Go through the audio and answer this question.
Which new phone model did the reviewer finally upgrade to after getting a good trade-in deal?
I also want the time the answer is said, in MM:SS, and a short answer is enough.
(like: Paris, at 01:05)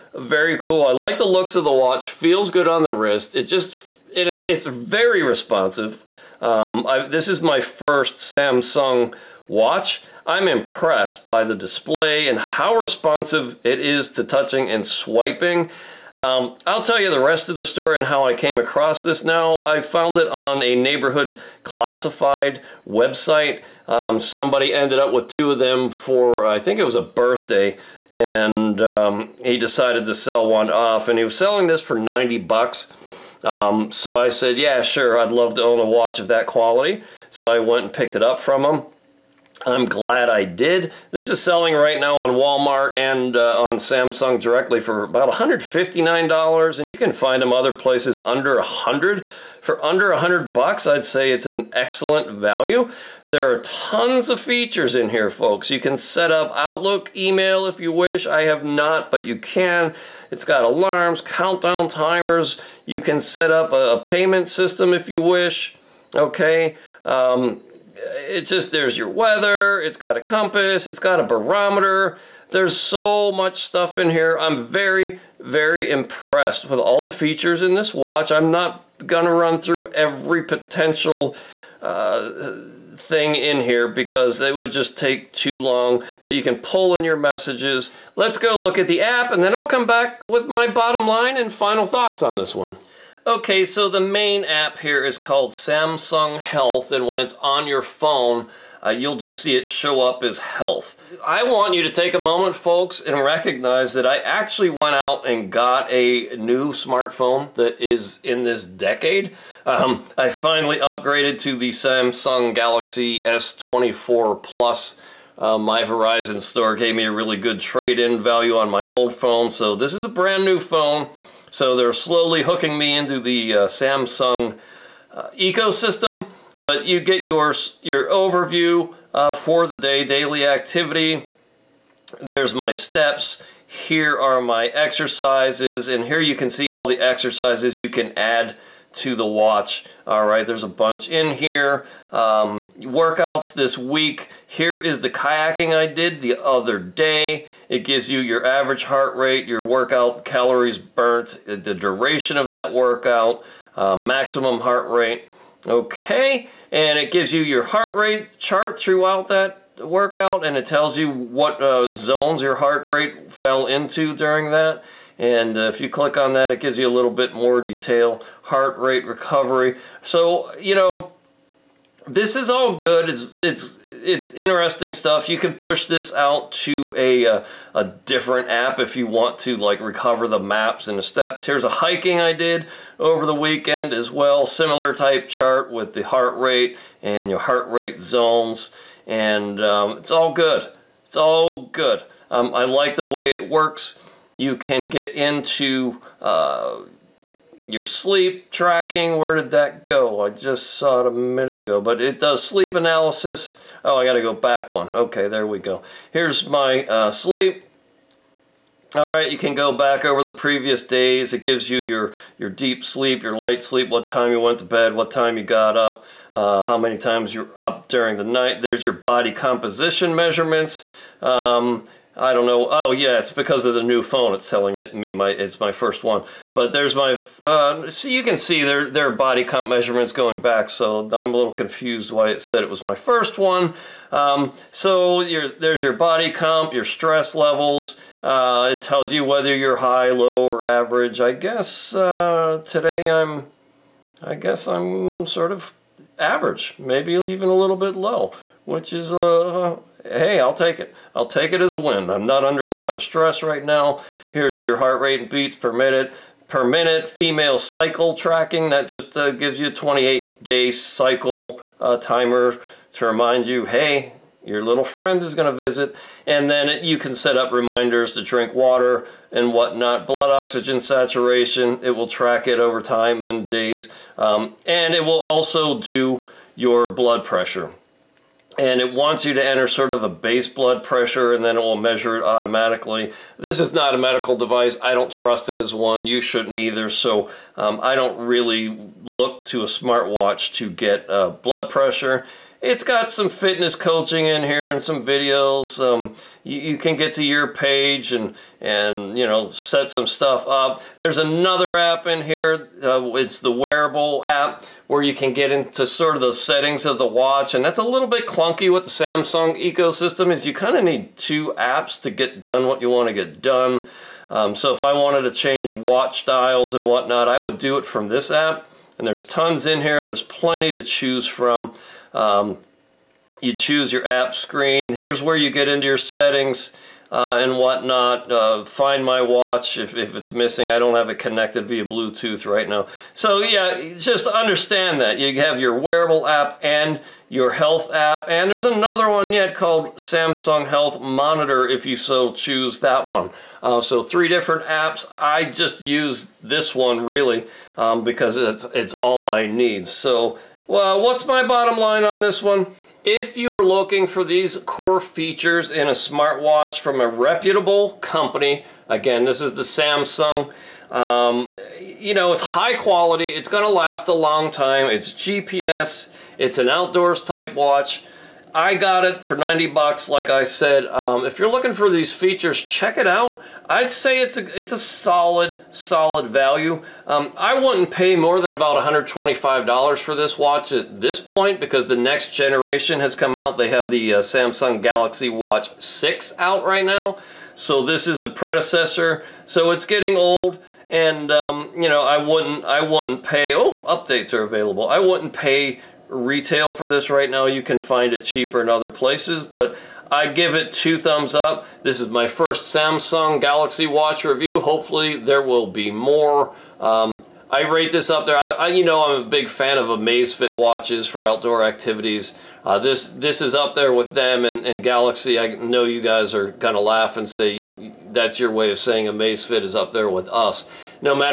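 Samsung Galaxy S24 Plus, at 01:51.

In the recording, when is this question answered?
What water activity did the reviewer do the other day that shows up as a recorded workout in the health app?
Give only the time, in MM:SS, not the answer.
02:25.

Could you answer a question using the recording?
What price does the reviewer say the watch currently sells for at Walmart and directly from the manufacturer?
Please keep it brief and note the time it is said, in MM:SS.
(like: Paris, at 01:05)
$159, at 00:45.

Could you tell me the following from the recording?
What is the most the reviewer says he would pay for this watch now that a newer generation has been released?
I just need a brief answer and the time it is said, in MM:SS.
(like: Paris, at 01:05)
$125, at 06:18.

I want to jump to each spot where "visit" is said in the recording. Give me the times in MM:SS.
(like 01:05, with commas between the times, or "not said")
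04:25.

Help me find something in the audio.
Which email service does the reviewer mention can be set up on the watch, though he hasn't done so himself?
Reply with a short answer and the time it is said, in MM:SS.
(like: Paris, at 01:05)
Outlook, at 00:56.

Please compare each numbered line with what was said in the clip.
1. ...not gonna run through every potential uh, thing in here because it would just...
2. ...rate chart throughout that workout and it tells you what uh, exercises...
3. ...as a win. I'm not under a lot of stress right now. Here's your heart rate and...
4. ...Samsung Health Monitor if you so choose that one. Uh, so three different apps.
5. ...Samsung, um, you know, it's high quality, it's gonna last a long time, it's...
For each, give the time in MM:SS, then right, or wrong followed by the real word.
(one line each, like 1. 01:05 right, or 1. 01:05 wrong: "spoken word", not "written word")
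1. 01:18 right
2. 02:37 wrong: "zones", not "exercises"
3. 04:11 right
4. 05:39 right
5. 05:59 right.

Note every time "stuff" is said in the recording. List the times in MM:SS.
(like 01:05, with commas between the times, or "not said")
01:13, 02:54, 05:00.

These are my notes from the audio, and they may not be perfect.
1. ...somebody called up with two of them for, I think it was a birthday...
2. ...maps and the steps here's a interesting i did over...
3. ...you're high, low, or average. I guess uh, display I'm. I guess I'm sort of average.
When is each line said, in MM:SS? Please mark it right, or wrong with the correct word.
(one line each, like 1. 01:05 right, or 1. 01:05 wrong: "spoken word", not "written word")
1. 00:24 wrong: "ended", not "called"
2. 03:00 wrong: "hiking", not "interesting"
3. 03:59 wrong: "today", not "display".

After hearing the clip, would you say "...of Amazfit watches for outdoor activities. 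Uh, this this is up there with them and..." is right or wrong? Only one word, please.
right.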